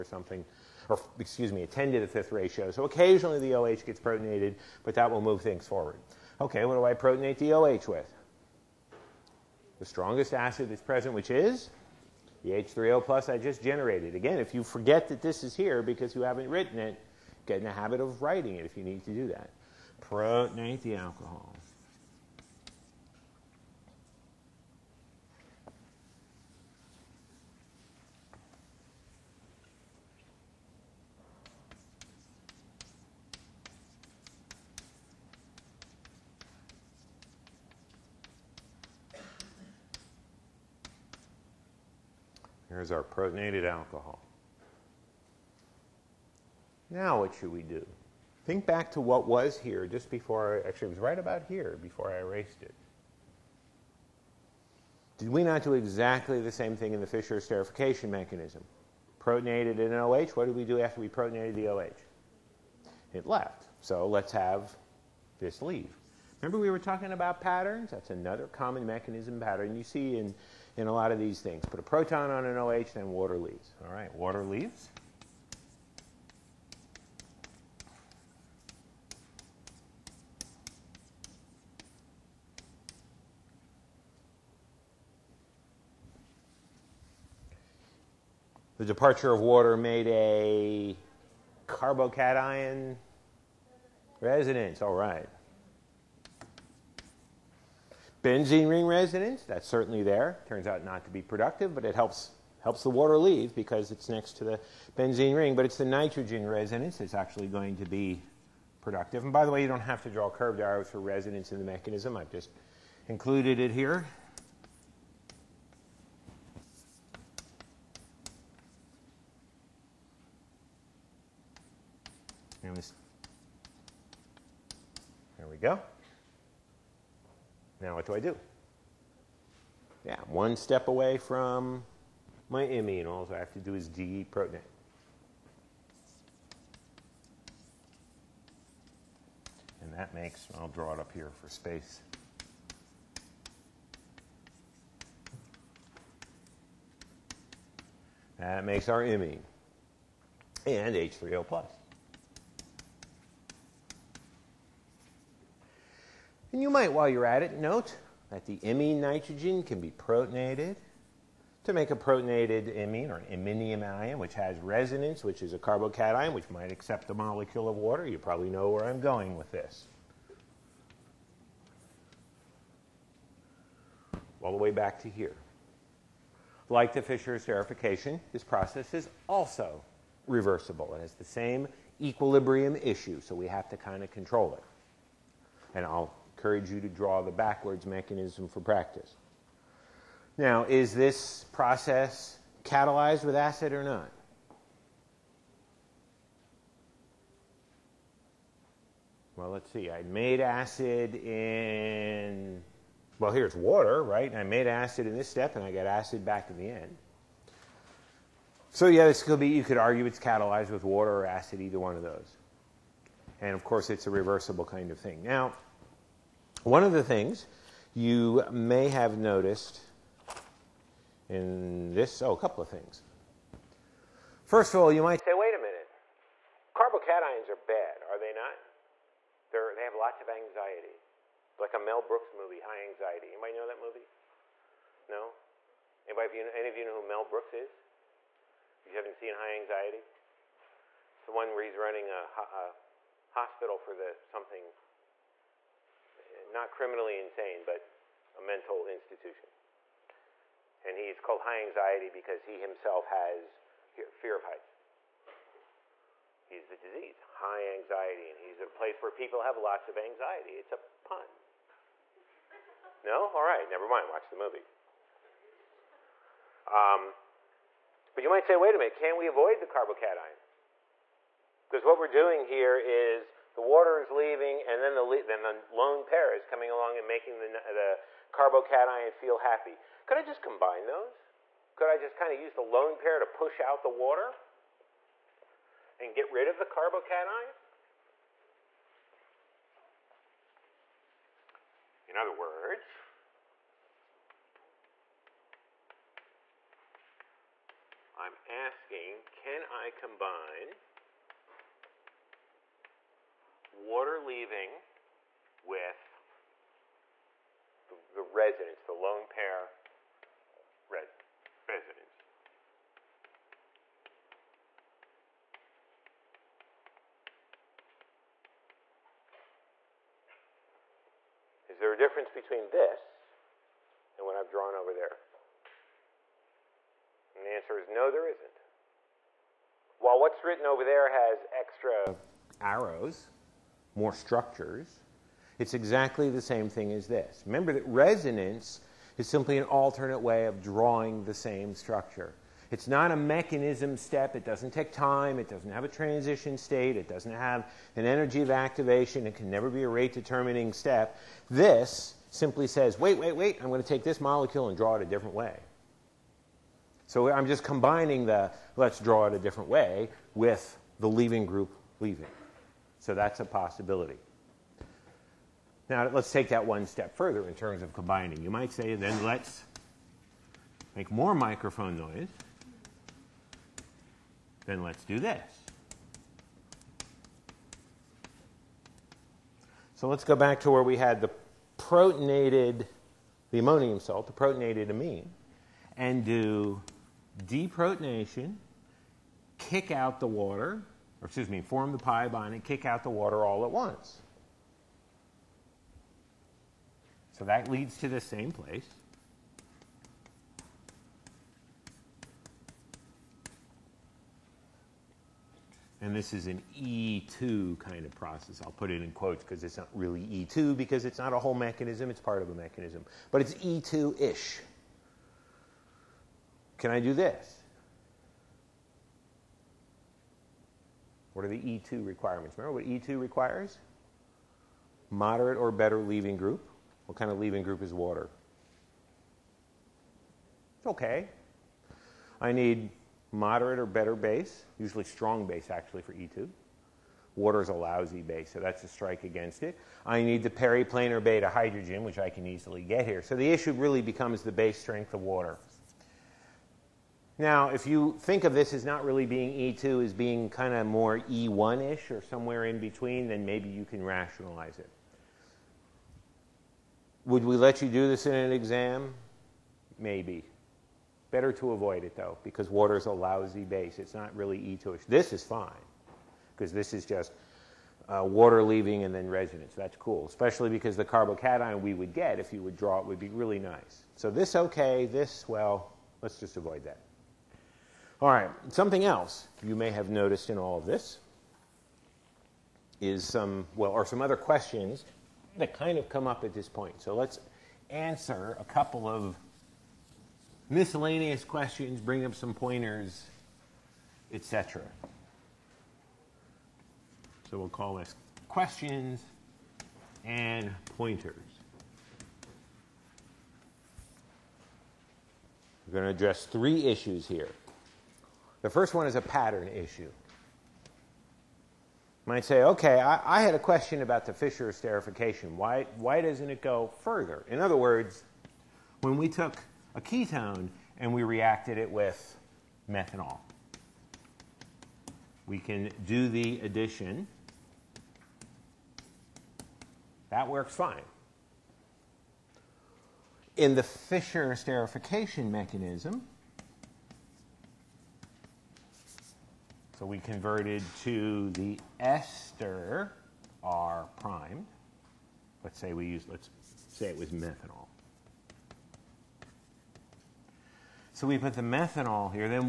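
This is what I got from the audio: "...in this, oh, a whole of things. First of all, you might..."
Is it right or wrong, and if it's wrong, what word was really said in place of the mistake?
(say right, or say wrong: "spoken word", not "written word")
wrong: "couple", not "whole".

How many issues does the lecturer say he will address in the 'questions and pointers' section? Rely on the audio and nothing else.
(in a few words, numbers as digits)
3.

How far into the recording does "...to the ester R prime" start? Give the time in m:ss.
9:01.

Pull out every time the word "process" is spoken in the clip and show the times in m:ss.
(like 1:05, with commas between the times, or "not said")
2:58, 3:11, 6:48.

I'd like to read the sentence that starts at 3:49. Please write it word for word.
They're, they have lots of anxiety.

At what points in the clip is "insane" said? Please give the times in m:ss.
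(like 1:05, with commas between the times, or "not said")
4:07.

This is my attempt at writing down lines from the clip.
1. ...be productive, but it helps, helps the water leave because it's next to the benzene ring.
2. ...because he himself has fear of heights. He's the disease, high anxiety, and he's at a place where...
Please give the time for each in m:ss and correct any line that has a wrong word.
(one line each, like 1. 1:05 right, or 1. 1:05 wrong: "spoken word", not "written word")
1. 1:41 right
2. 4:12 right.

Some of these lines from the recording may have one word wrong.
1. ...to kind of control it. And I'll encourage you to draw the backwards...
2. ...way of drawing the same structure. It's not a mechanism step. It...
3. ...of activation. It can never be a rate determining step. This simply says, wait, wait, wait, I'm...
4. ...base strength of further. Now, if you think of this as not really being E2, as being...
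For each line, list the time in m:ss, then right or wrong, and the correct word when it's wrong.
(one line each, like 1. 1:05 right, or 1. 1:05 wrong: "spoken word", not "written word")
1. 3:03 right
2. 5:40 right
3. 5:48 right
4. 7:24 wrong: "water", not "further".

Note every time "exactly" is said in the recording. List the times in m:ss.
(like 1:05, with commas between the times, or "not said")
0:55, 5:35.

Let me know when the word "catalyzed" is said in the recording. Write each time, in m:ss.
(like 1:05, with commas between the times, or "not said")
3:12, 3:30.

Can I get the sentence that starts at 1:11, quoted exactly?
Put a proton on an OH, then water leaves.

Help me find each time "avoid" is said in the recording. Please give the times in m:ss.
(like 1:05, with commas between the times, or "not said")
4:29, 7:41, 7:56.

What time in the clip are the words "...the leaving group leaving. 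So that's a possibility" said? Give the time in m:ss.
6:00.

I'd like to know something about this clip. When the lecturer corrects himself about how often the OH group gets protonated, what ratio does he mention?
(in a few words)
10 to the fifth.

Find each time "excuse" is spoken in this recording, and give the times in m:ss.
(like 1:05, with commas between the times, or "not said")
0:01, 6:31.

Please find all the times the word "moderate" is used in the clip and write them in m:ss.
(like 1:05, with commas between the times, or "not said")
7:05, 7:13.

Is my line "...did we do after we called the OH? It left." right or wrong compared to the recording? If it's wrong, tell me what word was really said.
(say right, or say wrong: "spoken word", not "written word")
wrong: "protonated", not "called".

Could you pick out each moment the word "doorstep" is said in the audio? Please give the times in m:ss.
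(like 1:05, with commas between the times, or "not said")
not said.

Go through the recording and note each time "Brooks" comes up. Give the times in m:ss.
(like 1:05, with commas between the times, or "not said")
3:52, 3:57.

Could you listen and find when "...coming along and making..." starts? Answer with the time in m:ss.
4:36.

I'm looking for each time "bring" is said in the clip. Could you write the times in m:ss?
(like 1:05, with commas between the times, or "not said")
8:11.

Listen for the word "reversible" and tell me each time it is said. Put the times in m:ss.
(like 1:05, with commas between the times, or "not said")
3:00, 3:34.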